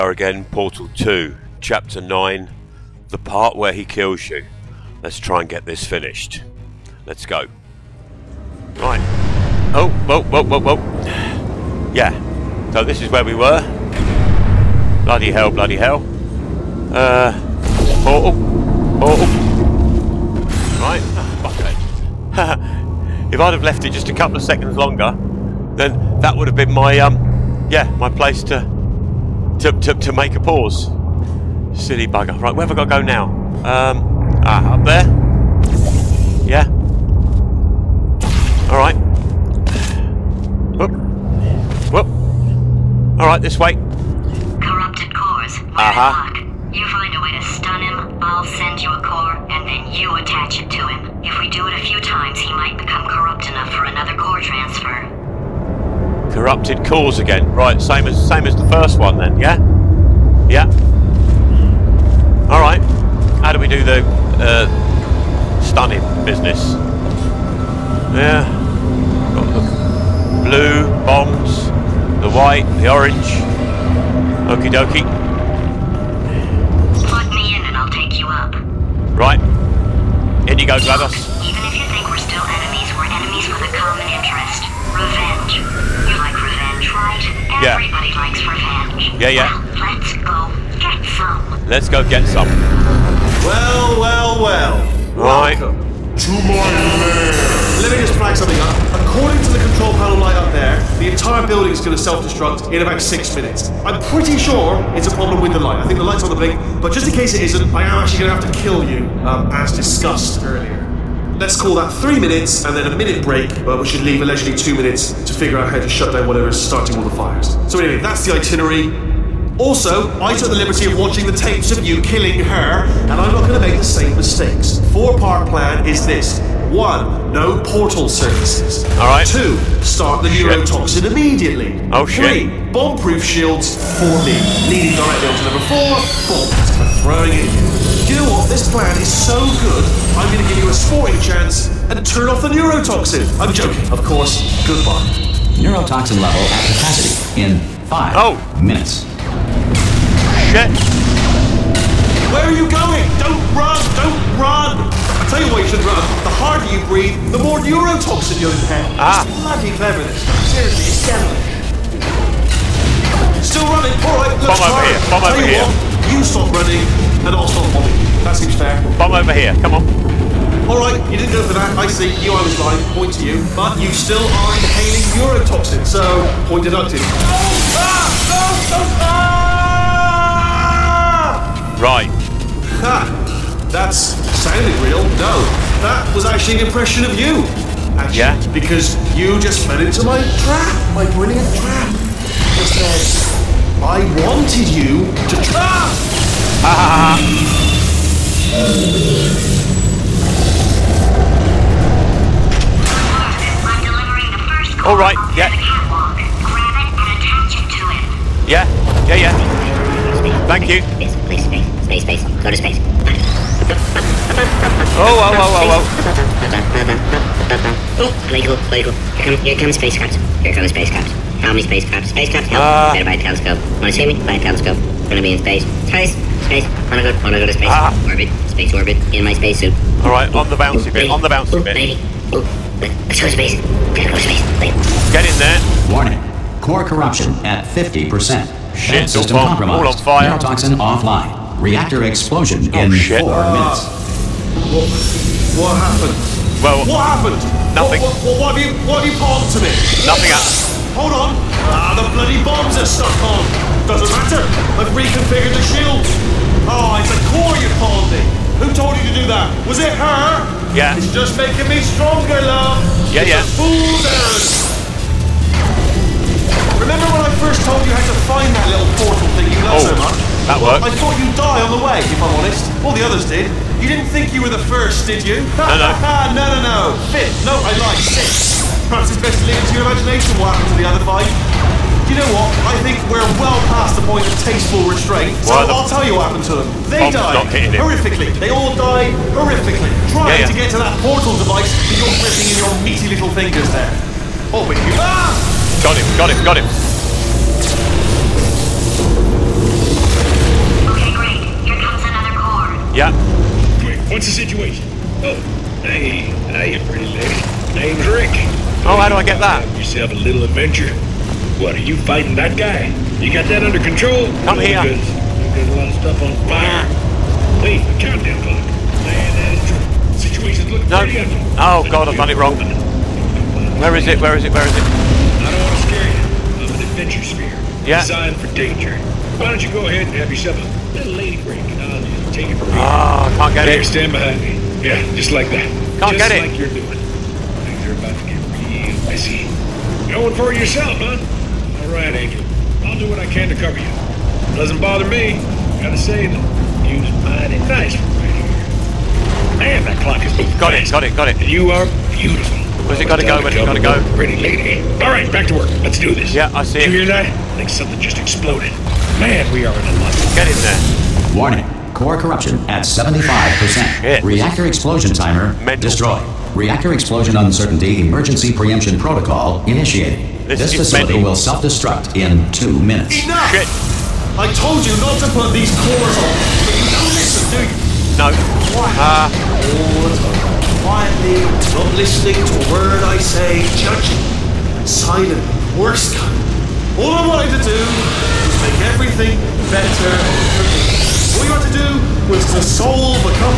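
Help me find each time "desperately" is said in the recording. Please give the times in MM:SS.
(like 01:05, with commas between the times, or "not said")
not said.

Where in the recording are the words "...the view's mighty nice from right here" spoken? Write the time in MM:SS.
05:46.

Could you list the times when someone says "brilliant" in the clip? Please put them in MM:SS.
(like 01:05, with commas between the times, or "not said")
03:11.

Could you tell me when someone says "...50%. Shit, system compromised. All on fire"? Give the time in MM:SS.
03:57.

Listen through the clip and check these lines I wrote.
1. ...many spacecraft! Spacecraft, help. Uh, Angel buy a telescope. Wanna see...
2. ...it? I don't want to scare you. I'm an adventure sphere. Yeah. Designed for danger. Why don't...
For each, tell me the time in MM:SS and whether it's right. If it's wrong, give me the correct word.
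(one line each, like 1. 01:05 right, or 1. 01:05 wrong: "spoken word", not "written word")
1. 03:41 wrong: "Better", not "Angel"
2. 05:24 right.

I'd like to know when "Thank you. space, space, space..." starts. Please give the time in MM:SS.
03:30.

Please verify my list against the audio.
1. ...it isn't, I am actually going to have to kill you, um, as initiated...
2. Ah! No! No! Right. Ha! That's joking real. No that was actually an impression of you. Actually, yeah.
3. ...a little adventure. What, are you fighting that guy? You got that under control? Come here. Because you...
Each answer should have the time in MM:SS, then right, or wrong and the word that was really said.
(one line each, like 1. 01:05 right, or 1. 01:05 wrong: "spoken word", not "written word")
1. 01:47 wrong: "discussed", not "initiated"
2. 02:57 wrong: "sounding", not "joking"
3. 05:10 right.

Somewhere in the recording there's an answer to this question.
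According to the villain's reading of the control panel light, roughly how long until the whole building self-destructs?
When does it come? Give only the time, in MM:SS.
01:43.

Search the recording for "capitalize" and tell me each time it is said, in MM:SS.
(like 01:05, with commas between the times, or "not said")
not said.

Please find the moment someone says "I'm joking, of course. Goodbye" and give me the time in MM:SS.
02:23.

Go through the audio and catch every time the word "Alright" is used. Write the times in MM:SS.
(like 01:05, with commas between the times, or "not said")
00:38, 00:43, 01:02, 03:50.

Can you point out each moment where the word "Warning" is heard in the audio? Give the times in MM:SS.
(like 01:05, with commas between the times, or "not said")
03:55, 06:01.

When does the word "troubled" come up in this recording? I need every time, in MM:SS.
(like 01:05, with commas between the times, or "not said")
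not said.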